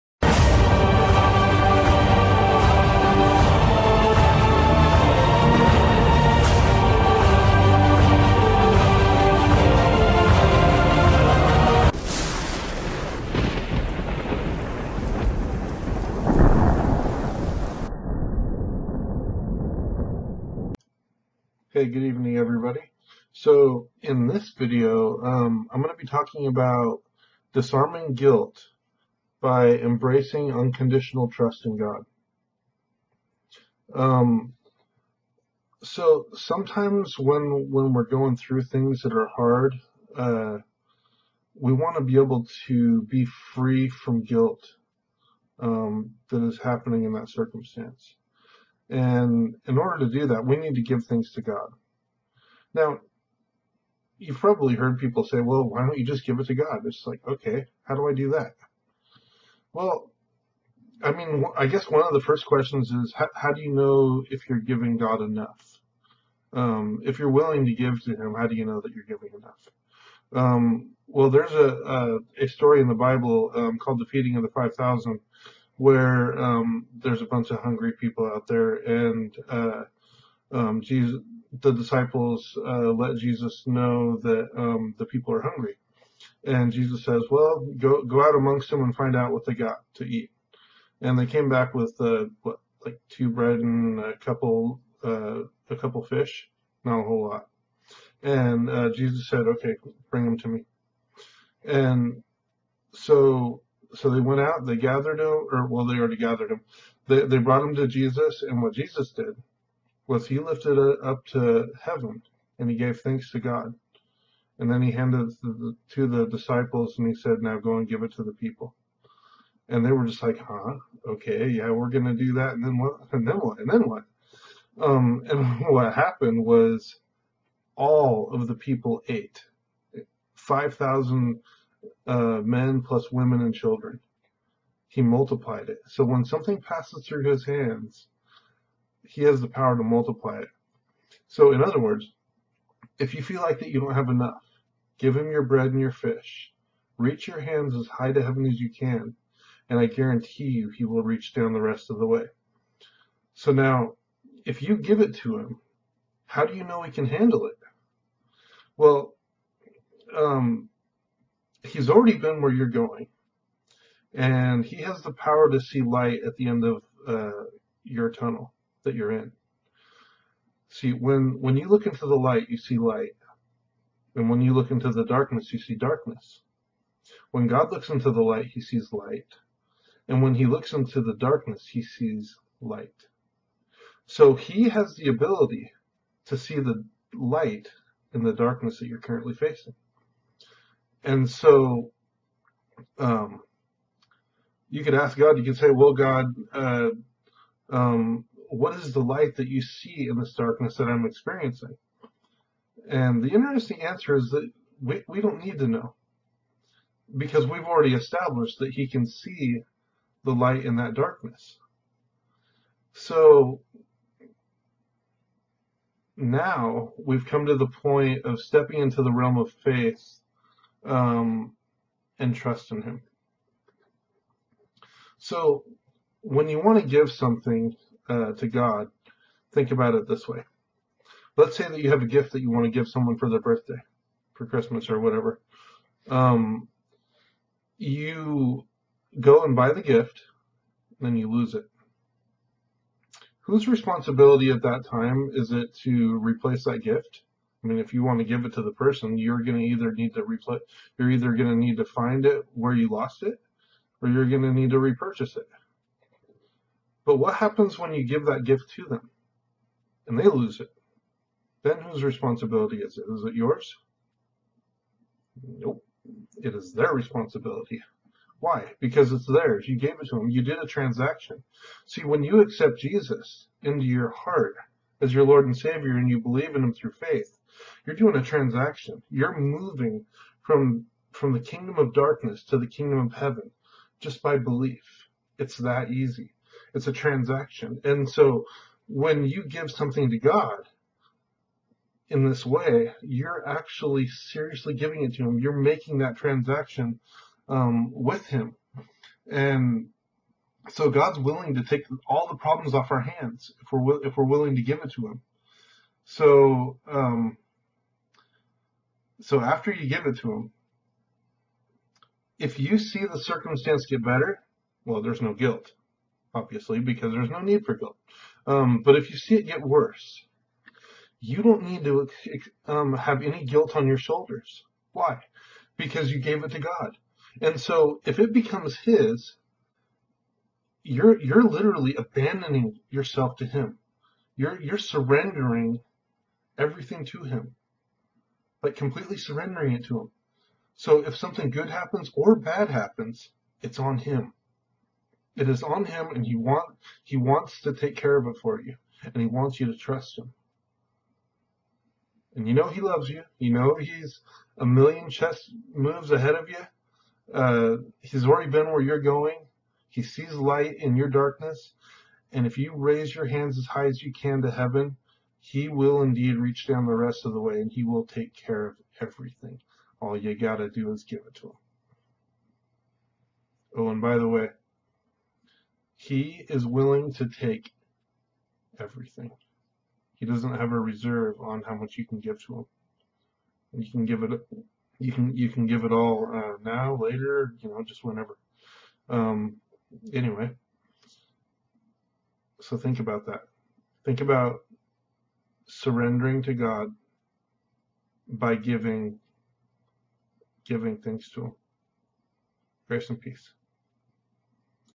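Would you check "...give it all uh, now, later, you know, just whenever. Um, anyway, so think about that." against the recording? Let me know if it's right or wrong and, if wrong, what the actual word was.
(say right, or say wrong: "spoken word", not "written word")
right.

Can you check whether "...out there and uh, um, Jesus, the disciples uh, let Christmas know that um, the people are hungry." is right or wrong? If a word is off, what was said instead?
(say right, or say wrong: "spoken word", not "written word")
wrong: "Jesus", not "Christmas".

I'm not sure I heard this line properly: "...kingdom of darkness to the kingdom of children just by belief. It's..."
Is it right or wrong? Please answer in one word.
wrong.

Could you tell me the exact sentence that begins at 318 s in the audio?
Um, but if you see it get worse, you don't need to um, have any guilt on your shoulders.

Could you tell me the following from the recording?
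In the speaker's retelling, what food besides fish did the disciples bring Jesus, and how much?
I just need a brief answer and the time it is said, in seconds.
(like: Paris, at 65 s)
Two bread, at 93 s.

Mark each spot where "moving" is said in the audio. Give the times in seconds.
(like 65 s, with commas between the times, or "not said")
279 s.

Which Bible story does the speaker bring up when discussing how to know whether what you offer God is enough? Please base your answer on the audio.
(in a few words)
The feeding of the 5,000.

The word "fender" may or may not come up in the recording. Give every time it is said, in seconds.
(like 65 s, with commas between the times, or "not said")
not said.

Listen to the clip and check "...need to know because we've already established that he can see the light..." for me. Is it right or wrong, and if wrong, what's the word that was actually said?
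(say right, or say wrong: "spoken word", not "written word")
right.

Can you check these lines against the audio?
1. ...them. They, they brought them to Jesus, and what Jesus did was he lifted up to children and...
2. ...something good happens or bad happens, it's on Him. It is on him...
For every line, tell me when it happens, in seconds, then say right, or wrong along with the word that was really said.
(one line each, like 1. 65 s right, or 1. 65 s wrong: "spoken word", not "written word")
1. 106 s wrong: "heaven", not "children"
2. 341 s right.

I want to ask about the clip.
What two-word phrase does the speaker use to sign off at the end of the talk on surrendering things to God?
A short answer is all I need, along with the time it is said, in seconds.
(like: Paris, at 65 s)
Grace and peace, at 402 s.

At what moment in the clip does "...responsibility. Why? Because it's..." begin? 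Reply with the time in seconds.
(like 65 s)
266 s.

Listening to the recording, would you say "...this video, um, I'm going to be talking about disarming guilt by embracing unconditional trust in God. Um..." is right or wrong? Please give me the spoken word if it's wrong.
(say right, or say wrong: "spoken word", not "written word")
right.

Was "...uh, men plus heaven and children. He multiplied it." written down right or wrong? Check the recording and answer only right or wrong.
wrong.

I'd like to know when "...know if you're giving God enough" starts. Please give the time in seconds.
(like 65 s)
63 s.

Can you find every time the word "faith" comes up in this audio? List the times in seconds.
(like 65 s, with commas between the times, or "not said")
219 s, 276 s.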